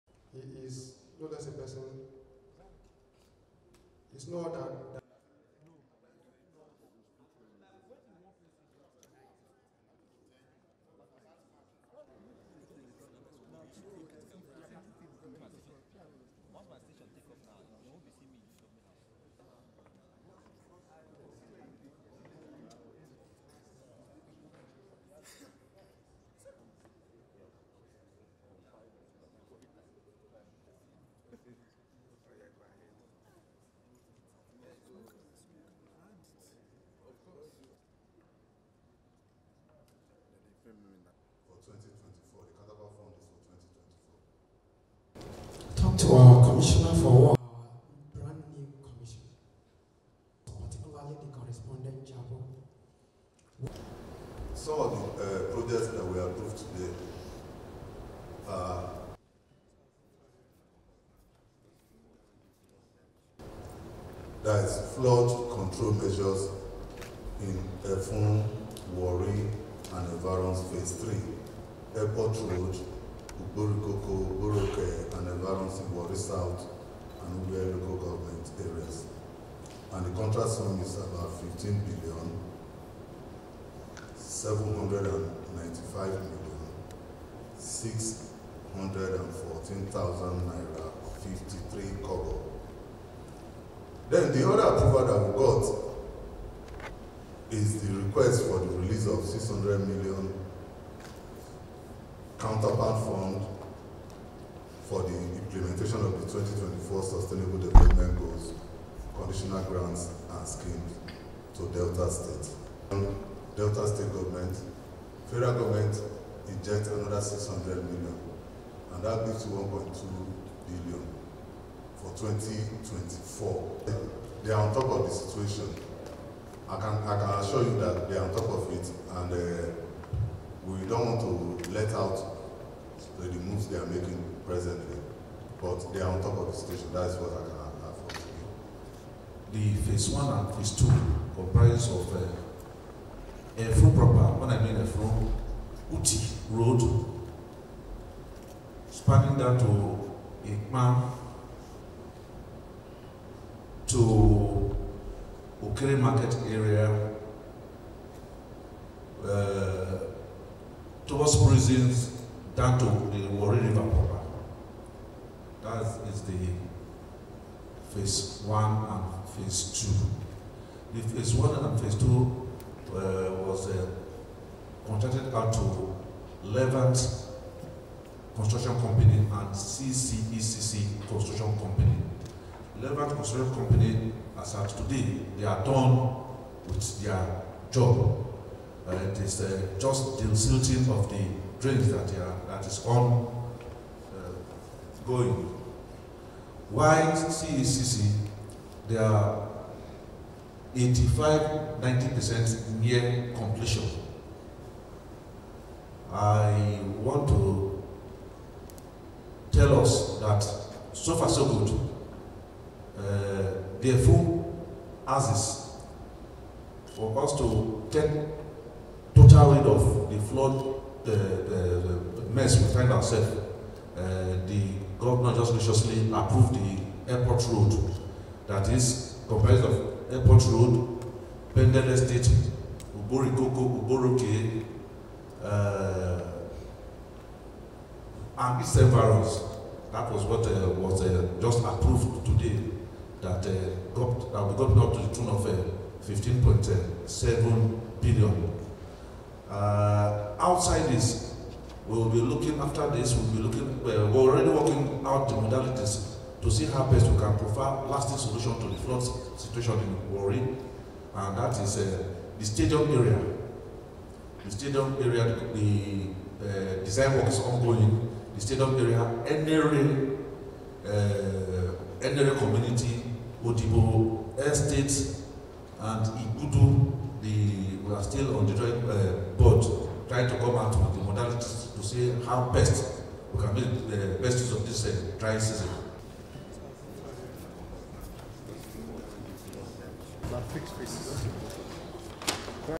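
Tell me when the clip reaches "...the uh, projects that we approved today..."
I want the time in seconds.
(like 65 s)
55 s.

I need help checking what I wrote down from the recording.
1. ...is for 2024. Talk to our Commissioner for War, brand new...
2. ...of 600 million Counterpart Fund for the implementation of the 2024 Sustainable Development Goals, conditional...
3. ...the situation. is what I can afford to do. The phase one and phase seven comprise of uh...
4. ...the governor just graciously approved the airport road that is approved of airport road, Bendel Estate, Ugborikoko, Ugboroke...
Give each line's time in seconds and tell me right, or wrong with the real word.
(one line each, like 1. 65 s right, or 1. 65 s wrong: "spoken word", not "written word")
1. 41 s right
2. 99 s right
3. 136 s wrong: "two", not "seven"
4. 224 s wrong: "comprised", not "approved".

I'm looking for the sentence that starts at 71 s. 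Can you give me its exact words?
Airport Road, Uburukoko, Uburuke, and environs in Wari South and Ubere local government areas.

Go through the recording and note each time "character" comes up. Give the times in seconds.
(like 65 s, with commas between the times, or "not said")
not said.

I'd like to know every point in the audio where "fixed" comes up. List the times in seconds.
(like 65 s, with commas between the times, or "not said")
290 s.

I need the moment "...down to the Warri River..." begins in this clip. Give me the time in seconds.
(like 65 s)
162 s.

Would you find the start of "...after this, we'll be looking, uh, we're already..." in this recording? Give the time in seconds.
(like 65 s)
252 s.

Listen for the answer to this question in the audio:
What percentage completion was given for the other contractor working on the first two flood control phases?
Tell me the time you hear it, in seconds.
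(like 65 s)
200 s.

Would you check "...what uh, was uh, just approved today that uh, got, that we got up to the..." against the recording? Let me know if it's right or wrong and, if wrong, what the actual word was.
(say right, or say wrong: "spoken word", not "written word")
right.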